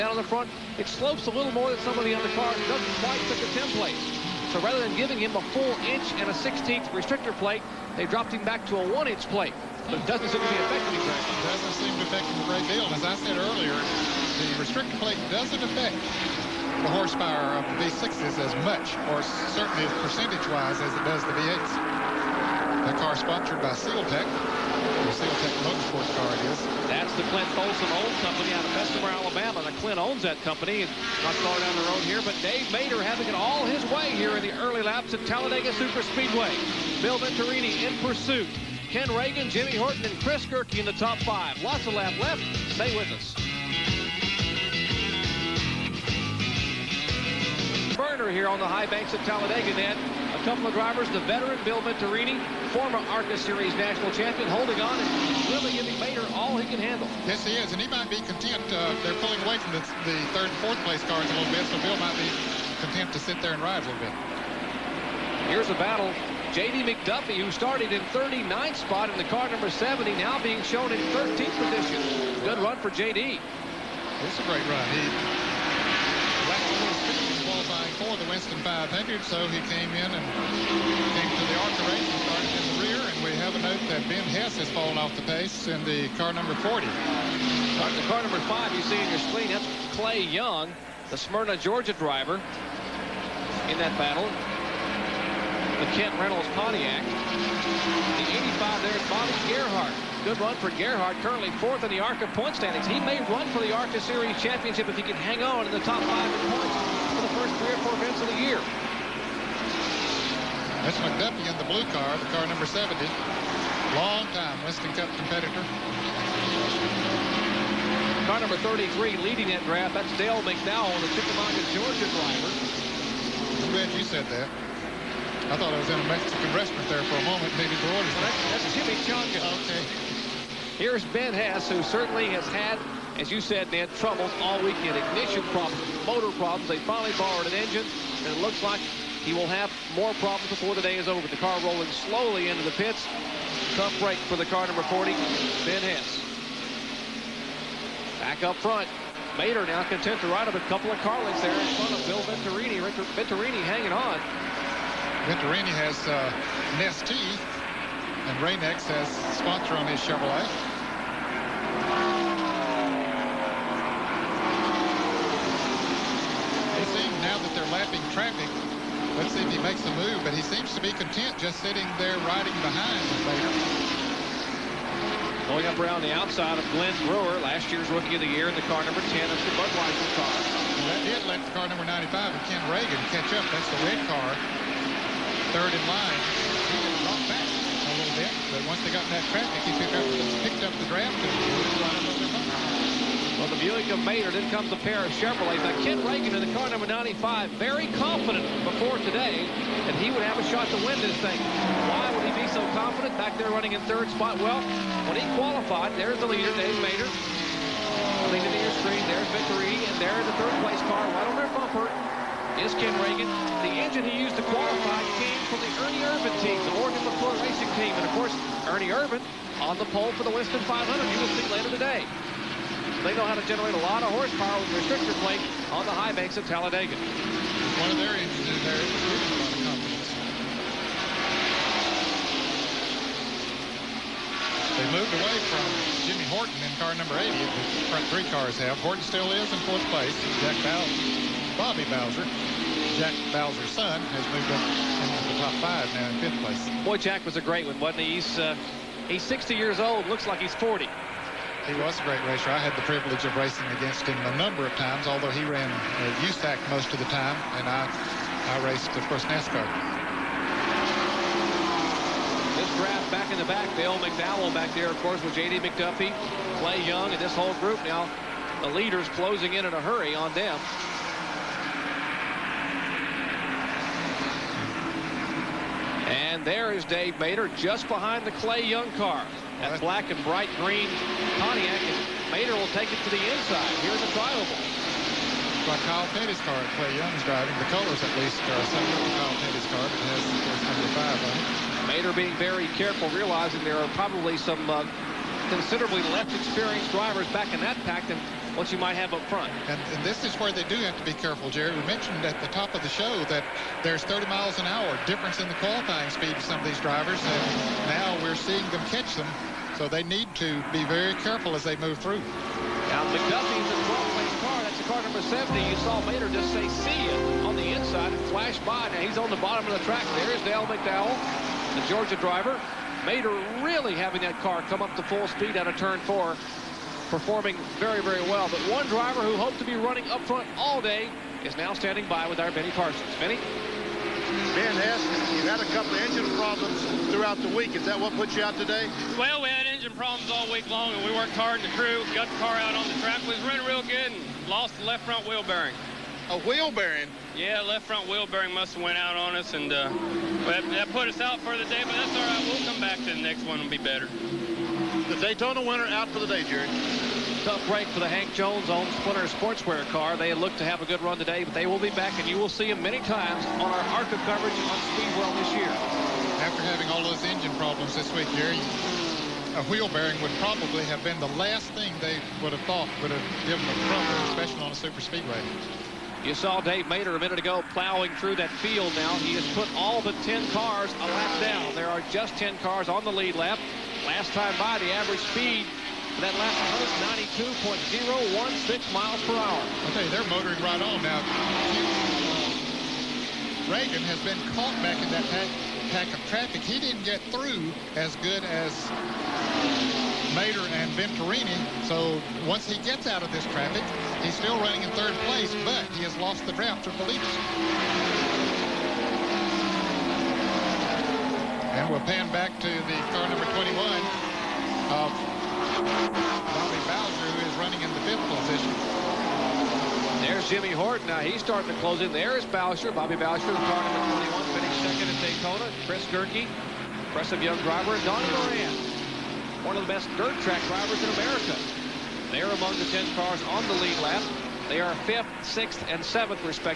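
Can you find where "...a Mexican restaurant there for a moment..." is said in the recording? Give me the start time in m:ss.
2:05.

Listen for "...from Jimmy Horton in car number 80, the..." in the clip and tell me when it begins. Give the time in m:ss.
3:55.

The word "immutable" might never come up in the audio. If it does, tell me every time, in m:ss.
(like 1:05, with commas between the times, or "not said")
not said.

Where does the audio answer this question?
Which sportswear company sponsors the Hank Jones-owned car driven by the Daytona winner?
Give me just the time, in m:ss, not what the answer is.
5:58.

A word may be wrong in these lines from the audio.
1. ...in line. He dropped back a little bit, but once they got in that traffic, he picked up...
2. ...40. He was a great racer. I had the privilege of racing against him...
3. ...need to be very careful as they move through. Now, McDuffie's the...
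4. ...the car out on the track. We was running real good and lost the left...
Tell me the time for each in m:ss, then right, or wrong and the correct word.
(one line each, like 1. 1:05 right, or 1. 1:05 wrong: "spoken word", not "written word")
1. 3:05 right
2. 4:10 right
3. 5:10 right
4. 5:42 right.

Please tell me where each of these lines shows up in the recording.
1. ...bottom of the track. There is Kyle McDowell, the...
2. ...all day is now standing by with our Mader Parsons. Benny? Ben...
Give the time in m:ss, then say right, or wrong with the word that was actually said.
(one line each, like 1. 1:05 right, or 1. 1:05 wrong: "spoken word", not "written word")
1. 5:19 wrong: "Dale", not "Kyle"
2. 5:30 wrong: "Benny", not "Mader".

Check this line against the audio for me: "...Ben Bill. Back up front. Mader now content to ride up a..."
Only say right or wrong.
wrong.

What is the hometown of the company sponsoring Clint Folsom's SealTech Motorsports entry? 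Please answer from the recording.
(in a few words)
Bessemer, Alabama.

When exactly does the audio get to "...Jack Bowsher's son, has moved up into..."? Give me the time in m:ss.
4:02.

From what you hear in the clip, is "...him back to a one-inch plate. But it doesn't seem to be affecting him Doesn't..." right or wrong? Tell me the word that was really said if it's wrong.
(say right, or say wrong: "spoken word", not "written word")
right.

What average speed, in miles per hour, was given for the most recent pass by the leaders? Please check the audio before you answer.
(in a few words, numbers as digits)
92.016.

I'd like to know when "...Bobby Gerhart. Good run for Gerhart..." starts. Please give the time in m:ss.
1:39.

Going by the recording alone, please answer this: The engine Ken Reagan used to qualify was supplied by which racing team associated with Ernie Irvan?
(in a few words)
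Morgan McClure Racing.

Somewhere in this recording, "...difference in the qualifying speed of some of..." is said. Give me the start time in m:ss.
5:05.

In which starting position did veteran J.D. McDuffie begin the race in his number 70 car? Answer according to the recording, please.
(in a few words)
39th.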